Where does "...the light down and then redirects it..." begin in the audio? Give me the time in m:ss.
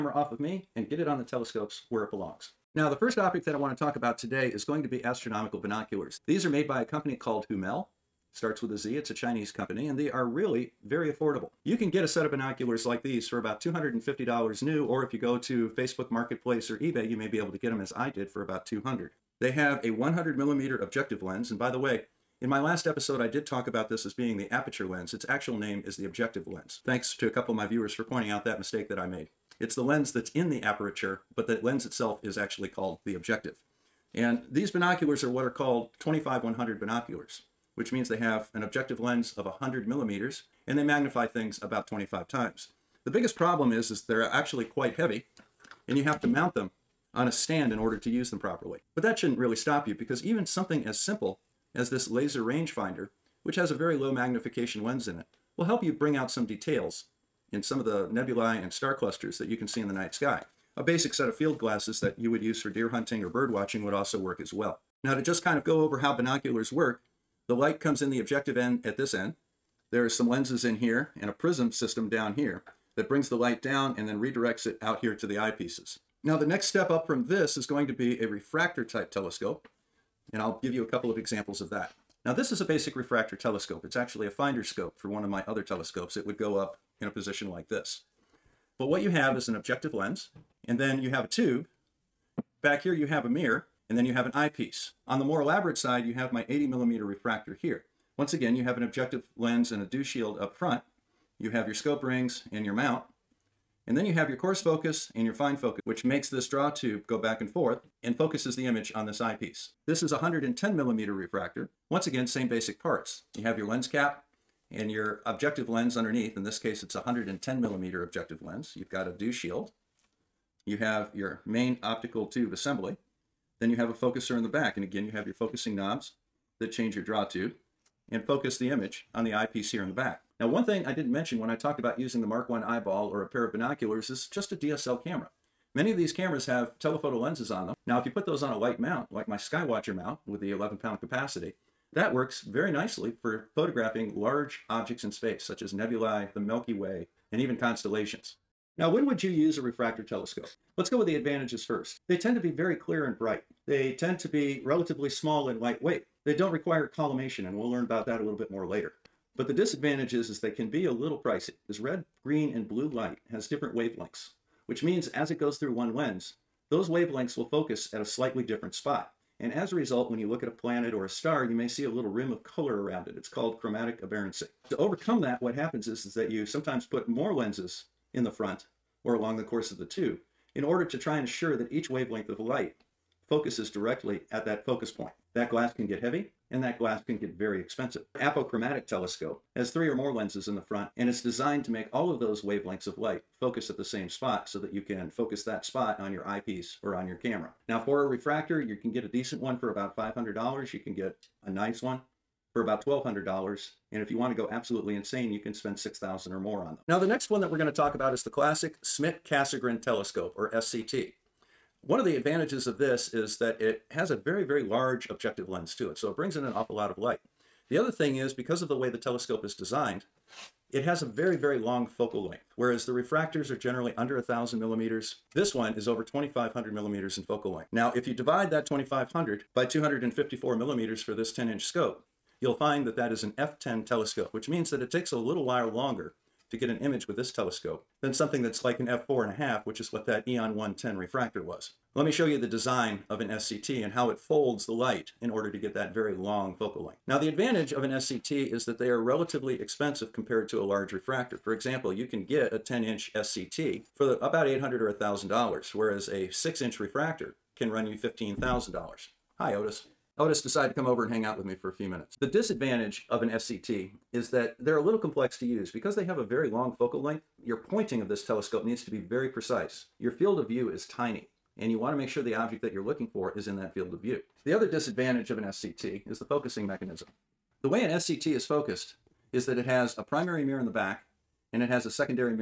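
1:13.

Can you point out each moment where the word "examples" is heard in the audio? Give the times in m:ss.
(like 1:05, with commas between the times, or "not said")
1:21, 4:11.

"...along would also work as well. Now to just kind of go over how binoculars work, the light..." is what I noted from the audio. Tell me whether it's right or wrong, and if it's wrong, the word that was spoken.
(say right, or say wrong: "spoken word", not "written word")
wrong: "watching", not "along".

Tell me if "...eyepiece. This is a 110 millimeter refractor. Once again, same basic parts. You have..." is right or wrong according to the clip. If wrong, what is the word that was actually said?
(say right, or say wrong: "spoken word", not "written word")
right.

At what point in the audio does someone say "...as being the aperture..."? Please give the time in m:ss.
0:24.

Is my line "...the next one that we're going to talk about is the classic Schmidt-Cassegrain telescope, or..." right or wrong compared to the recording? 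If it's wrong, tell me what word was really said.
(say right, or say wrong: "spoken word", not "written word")
right.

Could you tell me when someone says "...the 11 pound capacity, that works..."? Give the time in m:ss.
2:20.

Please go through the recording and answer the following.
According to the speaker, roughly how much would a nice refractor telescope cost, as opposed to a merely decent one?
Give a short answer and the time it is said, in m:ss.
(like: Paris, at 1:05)
$1,200, at 3:22.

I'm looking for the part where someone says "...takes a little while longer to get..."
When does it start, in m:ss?
3:54.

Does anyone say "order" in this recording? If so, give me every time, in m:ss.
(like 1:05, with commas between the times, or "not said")
0:47, 3:00, 4:05.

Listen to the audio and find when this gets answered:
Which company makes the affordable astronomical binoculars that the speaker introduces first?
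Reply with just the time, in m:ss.
0:07.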